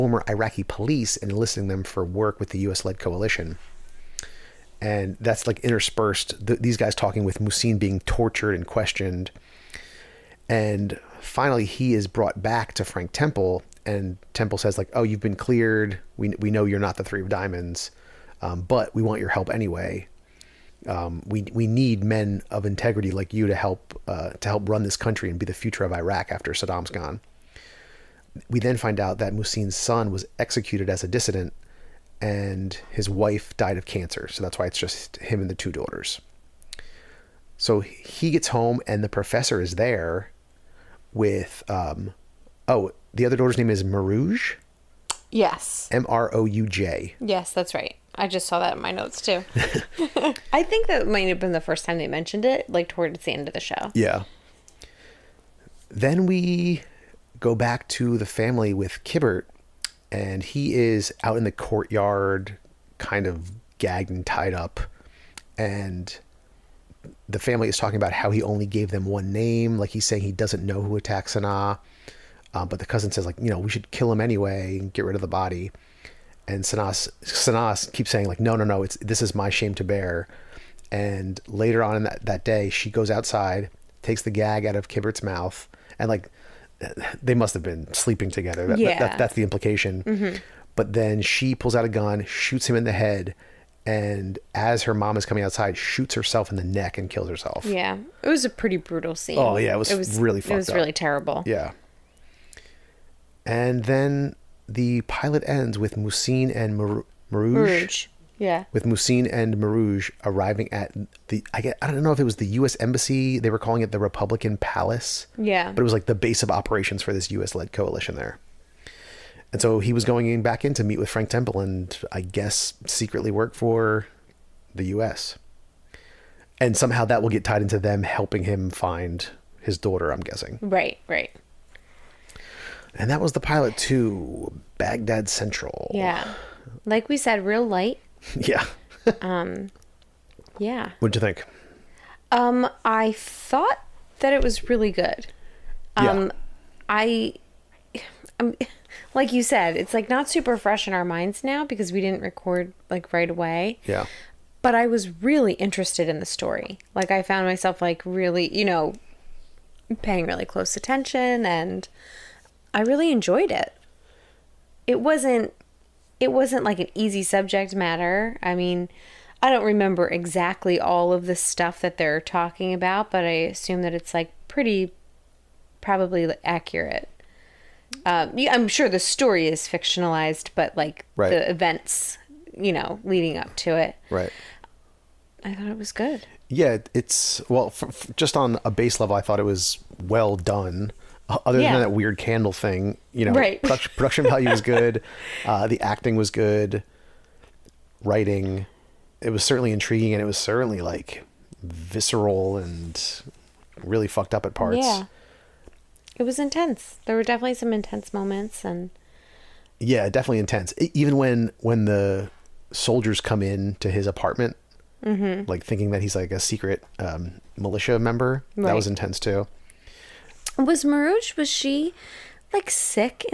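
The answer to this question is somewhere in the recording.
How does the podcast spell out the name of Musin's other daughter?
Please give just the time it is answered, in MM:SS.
00:45.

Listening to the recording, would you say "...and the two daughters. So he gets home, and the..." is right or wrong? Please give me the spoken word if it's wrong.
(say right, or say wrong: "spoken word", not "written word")
right.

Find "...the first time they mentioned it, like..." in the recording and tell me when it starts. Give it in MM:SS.
00:51.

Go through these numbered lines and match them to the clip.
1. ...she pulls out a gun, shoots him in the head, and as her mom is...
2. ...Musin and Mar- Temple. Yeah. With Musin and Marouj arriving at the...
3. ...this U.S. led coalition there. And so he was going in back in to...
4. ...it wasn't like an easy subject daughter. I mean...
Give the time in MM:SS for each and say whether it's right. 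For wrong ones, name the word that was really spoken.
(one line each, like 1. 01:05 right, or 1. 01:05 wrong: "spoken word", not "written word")
1. 01:31 right
2. 01:45 wrong: "Marouj", not "Temple"
3. 01:57 right
4. 02:46 wrong: "matter", not "daughter".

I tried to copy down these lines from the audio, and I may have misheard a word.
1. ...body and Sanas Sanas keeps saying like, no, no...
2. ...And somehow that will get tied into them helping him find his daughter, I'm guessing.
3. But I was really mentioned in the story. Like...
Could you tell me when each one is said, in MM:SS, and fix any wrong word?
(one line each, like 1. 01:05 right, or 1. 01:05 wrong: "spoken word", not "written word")
1. 01:15 right
2. 02:06 right
3. 02:34 wrong: "interested", not "mentioned".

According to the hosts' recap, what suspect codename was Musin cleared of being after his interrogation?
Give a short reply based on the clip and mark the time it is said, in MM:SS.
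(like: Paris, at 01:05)
Three of Diamonds, at 00:17.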